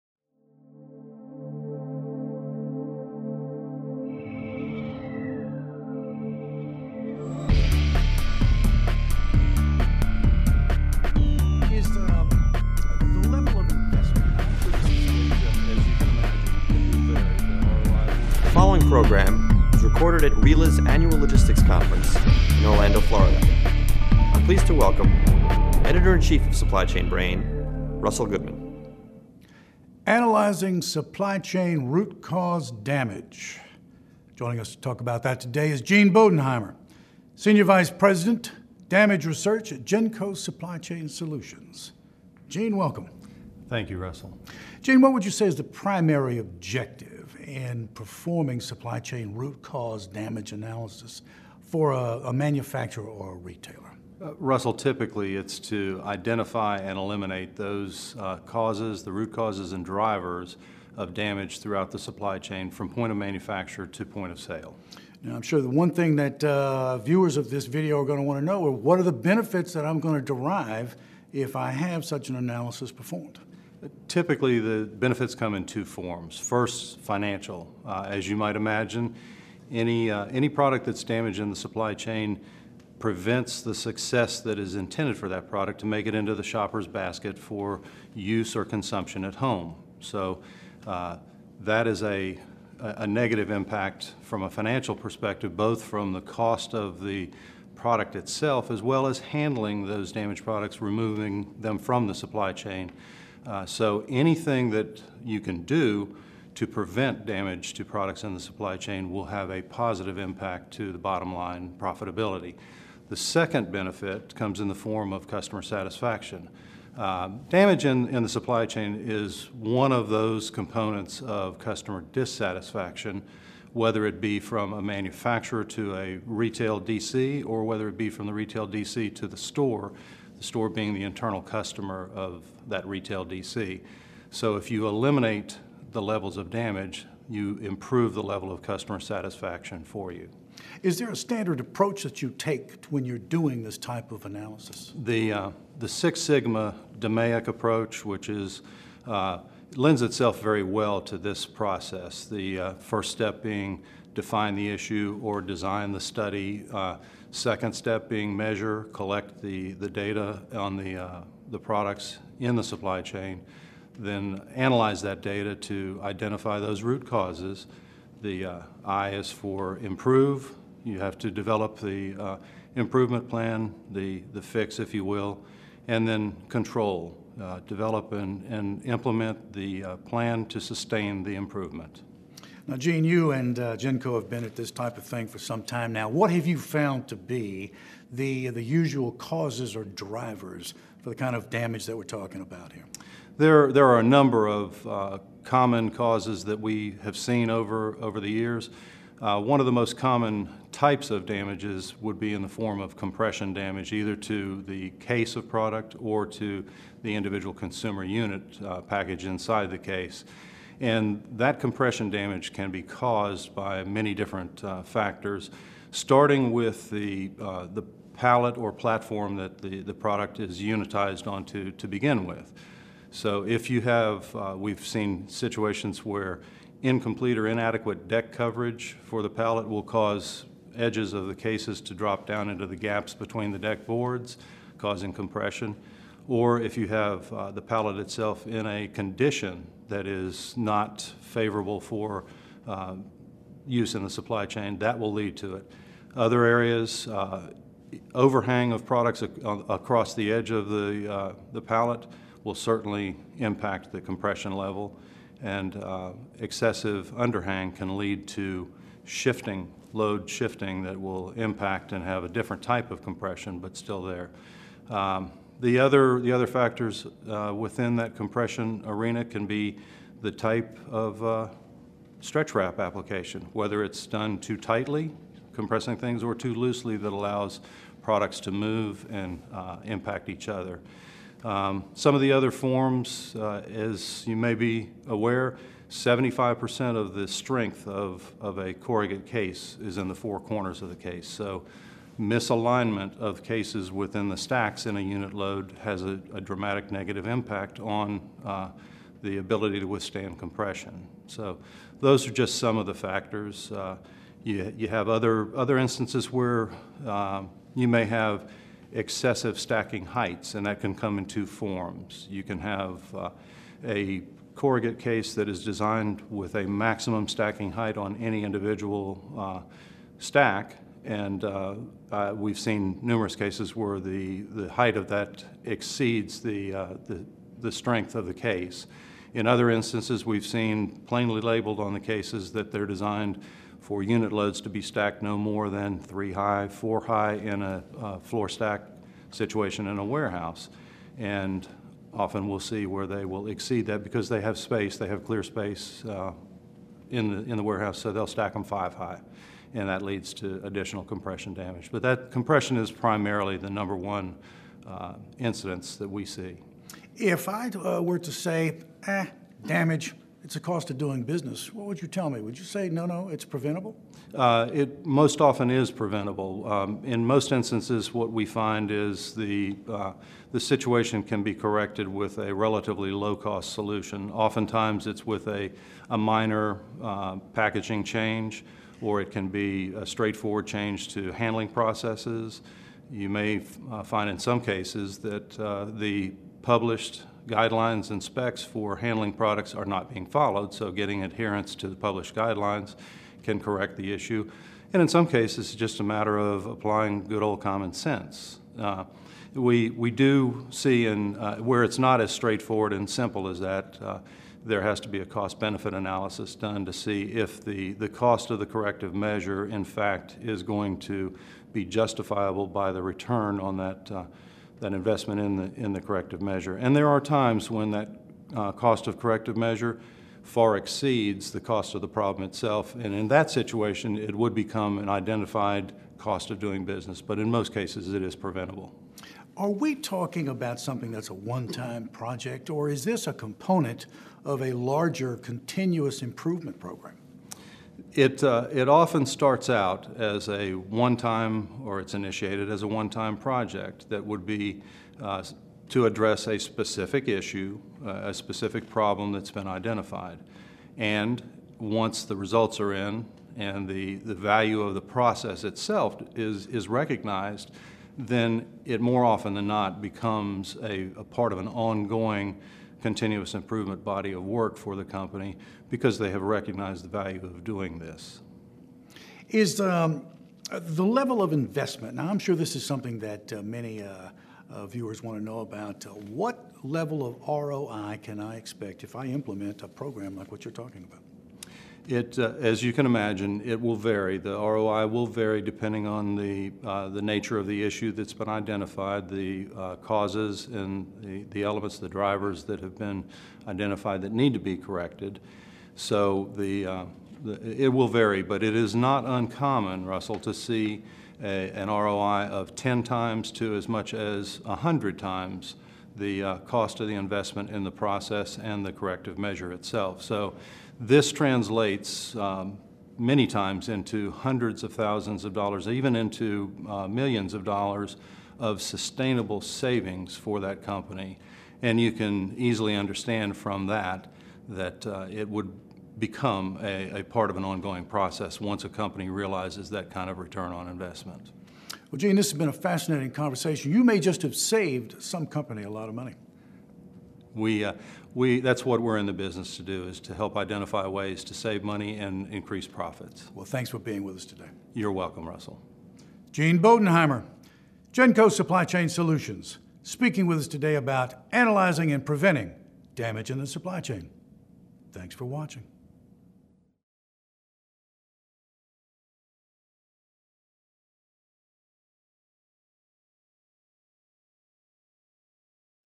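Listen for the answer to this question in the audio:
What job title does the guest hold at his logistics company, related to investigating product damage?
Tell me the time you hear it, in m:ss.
0:37.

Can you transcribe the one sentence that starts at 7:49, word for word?
Is um, the level of investment, now I'm sure this is something that uh, many uh, uh, viewers want to know about.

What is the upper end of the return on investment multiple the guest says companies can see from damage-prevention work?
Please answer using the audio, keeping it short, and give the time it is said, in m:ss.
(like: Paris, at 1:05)
100 times, at 8:24.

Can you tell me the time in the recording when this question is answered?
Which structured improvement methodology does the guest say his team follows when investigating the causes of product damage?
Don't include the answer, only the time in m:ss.
2:25.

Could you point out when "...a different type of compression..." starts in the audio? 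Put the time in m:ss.
4:22.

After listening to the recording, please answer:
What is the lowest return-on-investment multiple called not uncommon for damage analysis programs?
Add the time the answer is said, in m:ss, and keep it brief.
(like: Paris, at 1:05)
10 times, at 8:22.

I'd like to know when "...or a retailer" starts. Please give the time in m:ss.
0:53.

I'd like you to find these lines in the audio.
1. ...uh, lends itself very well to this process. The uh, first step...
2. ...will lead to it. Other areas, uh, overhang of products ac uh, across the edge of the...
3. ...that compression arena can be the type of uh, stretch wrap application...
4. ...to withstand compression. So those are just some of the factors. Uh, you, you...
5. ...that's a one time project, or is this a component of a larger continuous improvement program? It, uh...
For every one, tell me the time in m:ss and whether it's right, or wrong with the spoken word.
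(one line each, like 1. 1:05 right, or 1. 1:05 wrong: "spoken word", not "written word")
1. 2:29 right
2. 4:04 right
3. 4:27 right
4. 4:59 right
5. 7:11 right.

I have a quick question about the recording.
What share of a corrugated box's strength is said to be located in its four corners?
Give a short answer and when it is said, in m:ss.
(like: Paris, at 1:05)
75%, at 4:45.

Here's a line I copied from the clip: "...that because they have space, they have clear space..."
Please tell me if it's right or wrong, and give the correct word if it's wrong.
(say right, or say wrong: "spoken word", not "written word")
right.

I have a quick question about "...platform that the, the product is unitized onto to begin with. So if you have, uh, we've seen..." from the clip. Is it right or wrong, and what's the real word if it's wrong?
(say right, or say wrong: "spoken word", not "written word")
right.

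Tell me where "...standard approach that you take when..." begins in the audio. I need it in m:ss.
2:21.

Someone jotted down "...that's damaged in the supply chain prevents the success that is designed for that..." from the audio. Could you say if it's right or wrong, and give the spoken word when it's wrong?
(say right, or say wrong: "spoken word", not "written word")
wrong: "intended", not "designed".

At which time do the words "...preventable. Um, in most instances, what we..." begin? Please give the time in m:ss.
6:05.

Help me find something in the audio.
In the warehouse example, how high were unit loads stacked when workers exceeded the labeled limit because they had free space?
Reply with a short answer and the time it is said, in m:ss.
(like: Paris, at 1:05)
5 high, at 5:48.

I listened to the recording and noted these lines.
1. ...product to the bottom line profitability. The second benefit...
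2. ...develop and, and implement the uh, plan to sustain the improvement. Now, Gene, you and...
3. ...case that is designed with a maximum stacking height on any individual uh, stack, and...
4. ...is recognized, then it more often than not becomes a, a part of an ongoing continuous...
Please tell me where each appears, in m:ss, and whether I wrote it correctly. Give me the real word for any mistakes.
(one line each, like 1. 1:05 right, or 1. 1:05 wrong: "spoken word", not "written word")
1. 1:50 wrong: "impact", not "product"
2. 2:57 right
3. 5:14 right
4. 7:36 right.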